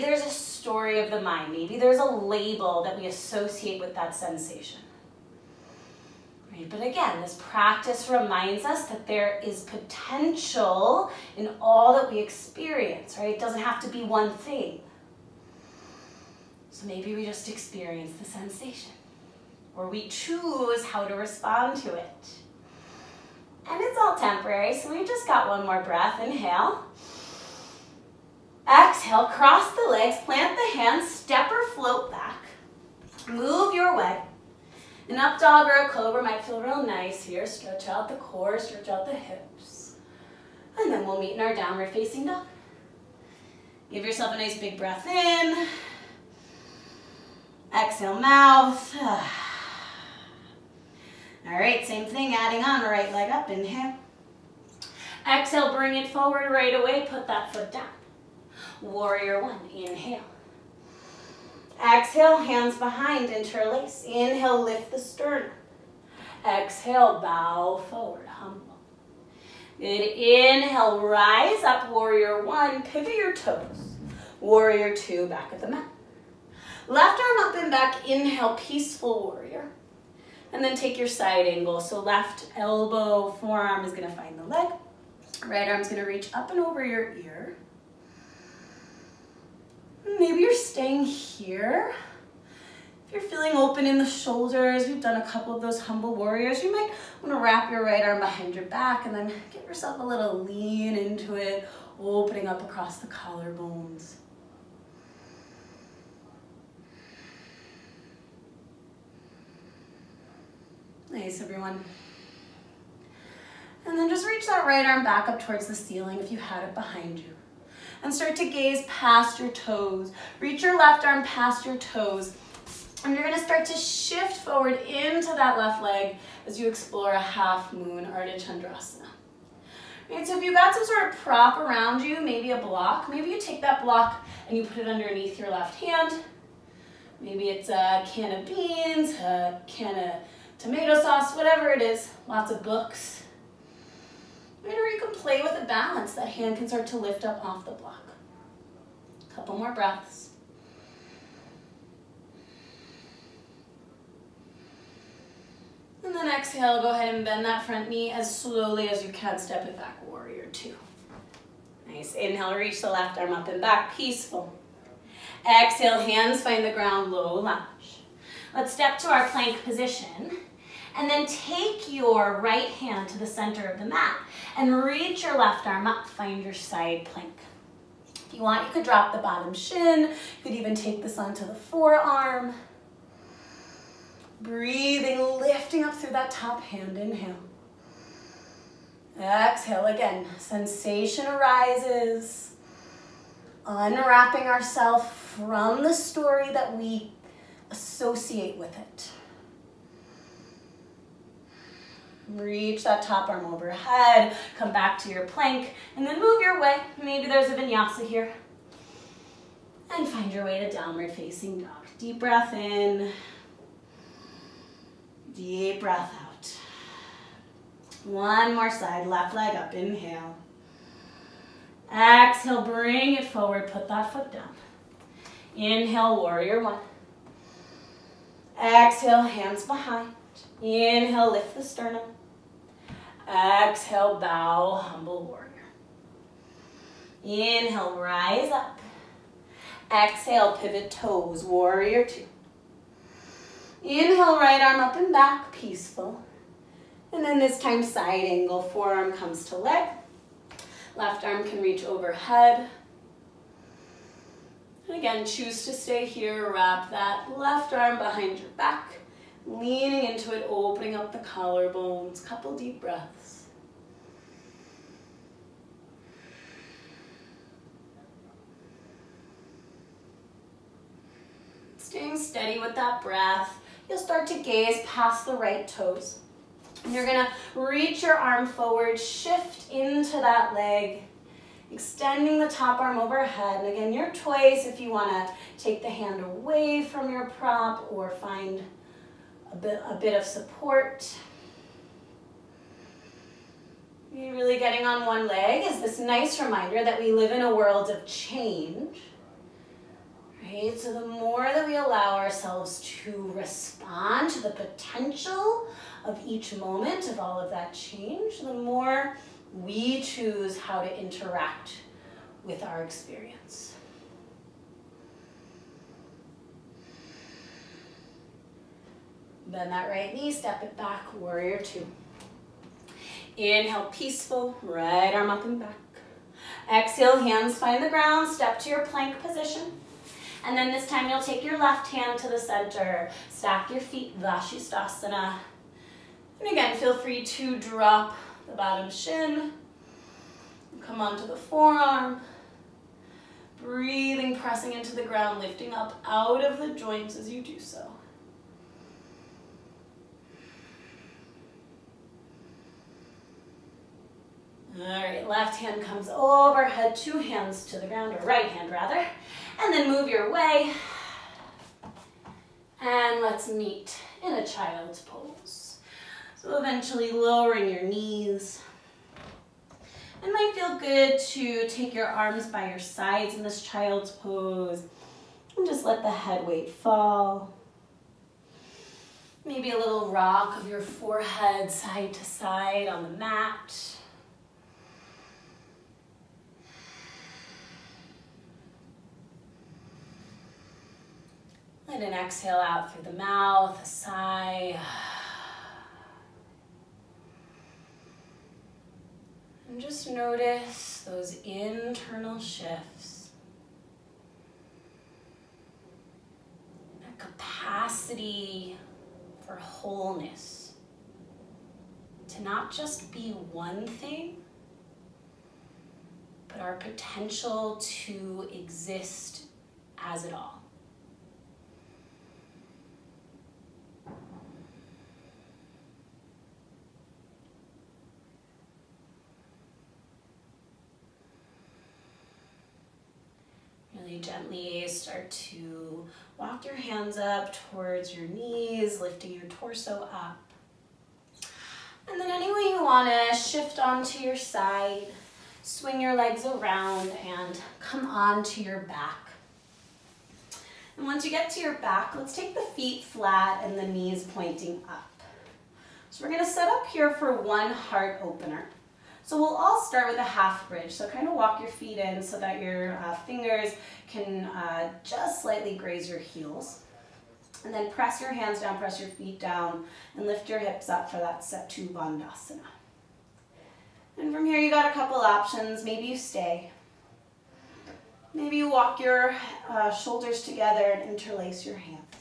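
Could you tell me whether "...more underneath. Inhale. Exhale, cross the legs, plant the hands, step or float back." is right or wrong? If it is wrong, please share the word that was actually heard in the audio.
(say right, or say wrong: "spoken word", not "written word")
wrong: "breath", not "underneath".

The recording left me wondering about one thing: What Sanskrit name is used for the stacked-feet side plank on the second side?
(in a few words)
Vashisthasana.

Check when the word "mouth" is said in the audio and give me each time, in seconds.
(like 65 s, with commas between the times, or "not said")
48 s, 393 s.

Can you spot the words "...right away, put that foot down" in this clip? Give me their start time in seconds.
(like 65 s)
56 s.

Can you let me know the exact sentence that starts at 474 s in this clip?
And from here, you got a couple options.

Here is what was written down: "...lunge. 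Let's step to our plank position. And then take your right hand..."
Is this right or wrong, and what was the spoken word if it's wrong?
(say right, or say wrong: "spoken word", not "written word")
right.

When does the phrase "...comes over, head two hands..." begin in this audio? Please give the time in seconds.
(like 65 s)
355 s.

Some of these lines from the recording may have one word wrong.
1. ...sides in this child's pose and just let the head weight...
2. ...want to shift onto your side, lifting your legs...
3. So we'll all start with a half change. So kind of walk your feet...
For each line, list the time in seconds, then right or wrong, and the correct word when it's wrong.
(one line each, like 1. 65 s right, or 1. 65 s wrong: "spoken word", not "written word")
1. 372 s right
2. 442 s wrong: "swing", not "lifting"
3. 459 s wrong: "bridge", not "change".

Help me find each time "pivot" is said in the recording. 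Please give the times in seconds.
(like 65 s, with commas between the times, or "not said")
72 s, 240 s.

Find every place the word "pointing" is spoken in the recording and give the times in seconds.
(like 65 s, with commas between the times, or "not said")
454 s.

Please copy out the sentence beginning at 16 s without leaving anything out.
So maybe we just experience the sensation where we choose how to respond to it.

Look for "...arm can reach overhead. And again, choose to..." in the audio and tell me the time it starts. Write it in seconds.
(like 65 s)
251 s.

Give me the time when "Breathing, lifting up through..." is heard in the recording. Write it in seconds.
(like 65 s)
184 s.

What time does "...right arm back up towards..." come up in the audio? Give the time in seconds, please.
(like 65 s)
114 s.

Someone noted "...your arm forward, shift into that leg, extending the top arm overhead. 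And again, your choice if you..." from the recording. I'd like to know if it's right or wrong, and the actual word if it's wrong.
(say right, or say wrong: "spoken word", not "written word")
right.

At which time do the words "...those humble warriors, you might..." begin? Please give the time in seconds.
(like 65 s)
95 s.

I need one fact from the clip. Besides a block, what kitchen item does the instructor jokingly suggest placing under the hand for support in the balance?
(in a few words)
a can of beans.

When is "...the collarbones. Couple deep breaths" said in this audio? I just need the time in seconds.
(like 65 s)
261 s.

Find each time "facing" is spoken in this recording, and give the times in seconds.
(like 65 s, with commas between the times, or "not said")
41 s, 211 s.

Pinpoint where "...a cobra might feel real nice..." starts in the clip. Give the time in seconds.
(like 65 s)
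35 s.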